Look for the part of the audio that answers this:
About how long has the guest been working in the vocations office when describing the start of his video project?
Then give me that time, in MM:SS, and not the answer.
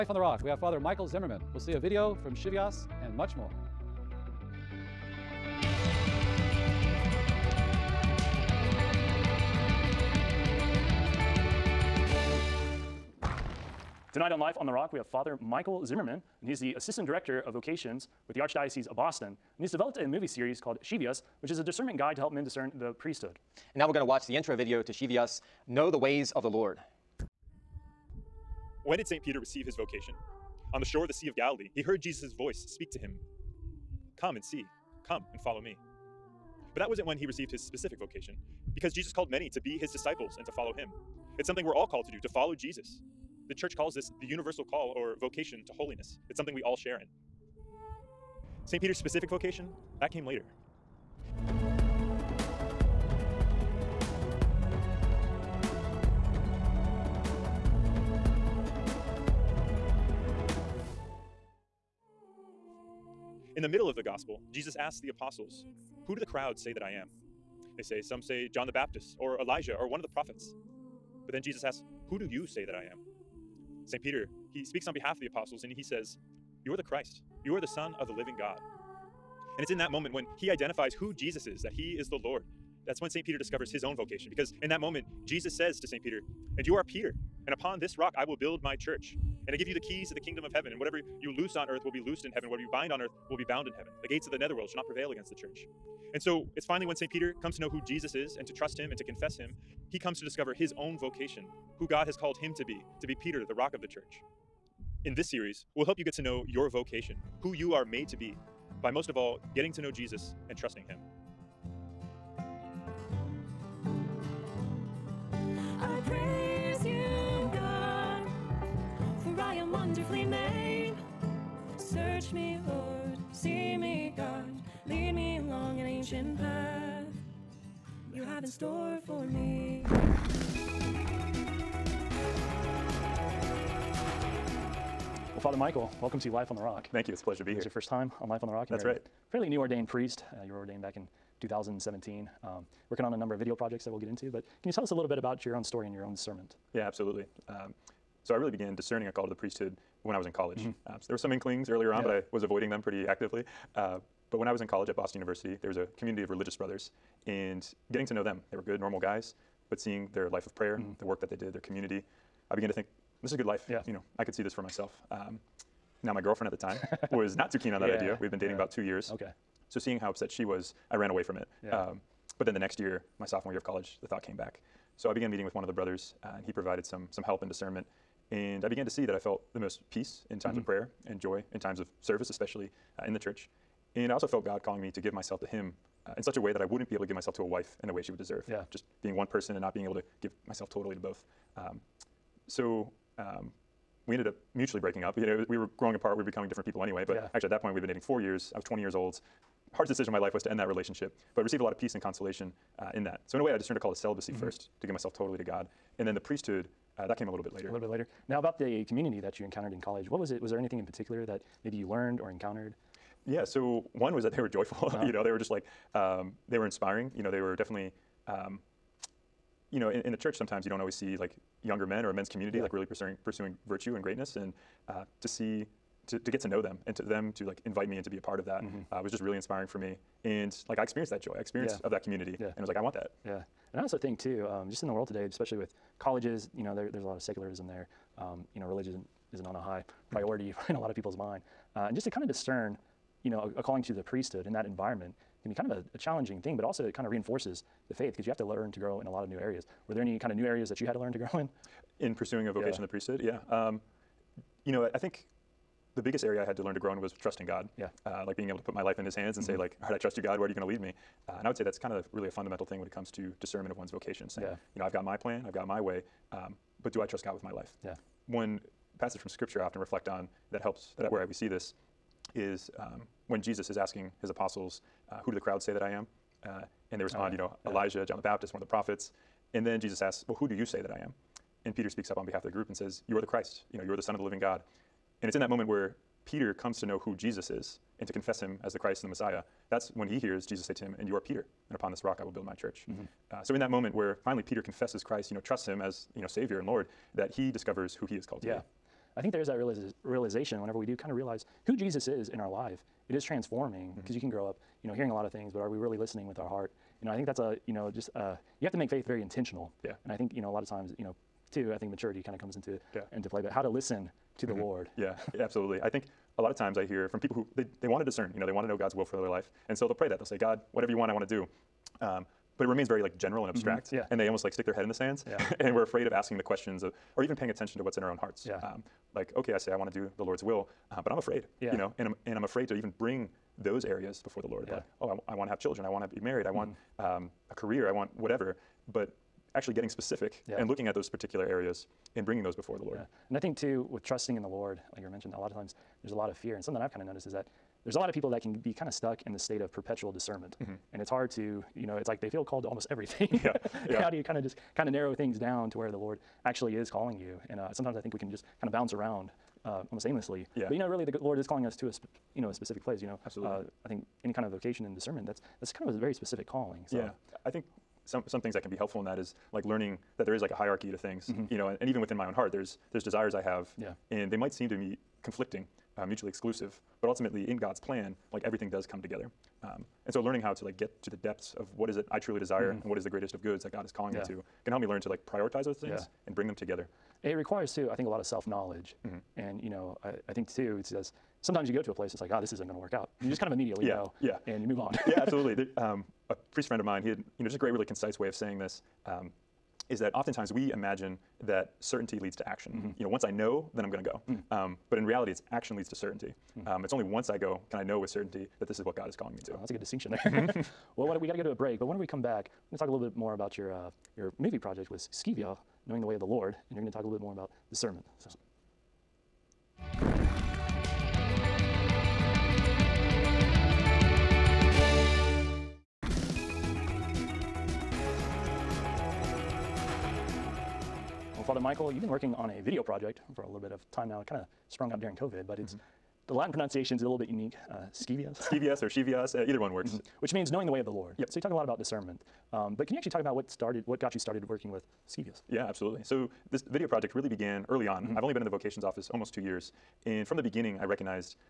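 07:29.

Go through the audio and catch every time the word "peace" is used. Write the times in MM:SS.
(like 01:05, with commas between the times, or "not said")
02:59, 03:21.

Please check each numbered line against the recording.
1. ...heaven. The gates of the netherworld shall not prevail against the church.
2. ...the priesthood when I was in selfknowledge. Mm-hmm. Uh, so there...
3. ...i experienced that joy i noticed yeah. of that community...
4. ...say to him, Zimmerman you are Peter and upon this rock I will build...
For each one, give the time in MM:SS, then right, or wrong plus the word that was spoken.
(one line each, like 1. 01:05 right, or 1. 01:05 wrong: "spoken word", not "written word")
1. 01:33 right
2. 02:29 wrong: "college", not "selfknowledge"
3. 03:50 wrong: "experienced", not "noticed"
4. 04:50 wrong: "And", not "Zimmerman".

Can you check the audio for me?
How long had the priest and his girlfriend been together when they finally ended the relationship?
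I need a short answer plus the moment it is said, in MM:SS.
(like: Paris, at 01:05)
4 years, at 03:17.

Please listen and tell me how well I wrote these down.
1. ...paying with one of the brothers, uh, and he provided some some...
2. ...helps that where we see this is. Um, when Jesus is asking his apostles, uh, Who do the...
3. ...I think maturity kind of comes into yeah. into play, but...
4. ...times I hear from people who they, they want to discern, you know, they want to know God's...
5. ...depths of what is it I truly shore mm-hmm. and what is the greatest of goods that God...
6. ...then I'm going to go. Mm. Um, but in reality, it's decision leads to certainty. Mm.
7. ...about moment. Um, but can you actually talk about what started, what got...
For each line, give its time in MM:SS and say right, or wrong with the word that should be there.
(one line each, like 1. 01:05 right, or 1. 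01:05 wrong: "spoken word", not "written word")
1. 02:55 wrong: "meeting", not "paying"
2. 04:30 right
3. 05:11 right
4. 05:16 right
5. 06:21 wrong: "desire", not "shore"
6. 06:43 wrong: "action", not "decision"
7. 07:21 wrong: "discernment", not "moment".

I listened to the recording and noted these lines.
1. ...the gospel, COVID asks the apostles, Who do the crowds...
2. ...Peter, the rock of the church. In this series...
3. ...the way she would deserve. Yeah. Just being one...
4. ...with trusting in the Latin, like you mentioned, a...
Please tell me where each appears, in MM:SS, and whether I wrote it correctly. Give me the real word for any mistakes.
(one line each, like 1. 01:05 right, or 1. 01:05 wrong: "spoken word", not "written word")
1. 01:03 wrong: "Jesus", not "COVID"
2. 01:43 right
3. 03:07 right
4. 05:43 wrong: "Lord", not "Latin".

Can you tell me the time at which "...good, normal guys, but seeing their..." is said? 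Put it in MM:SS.
02:38.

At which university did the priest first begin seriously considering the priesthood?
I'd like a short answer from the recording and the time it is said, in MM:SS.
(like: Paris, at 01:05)
Boston University, at 02:34.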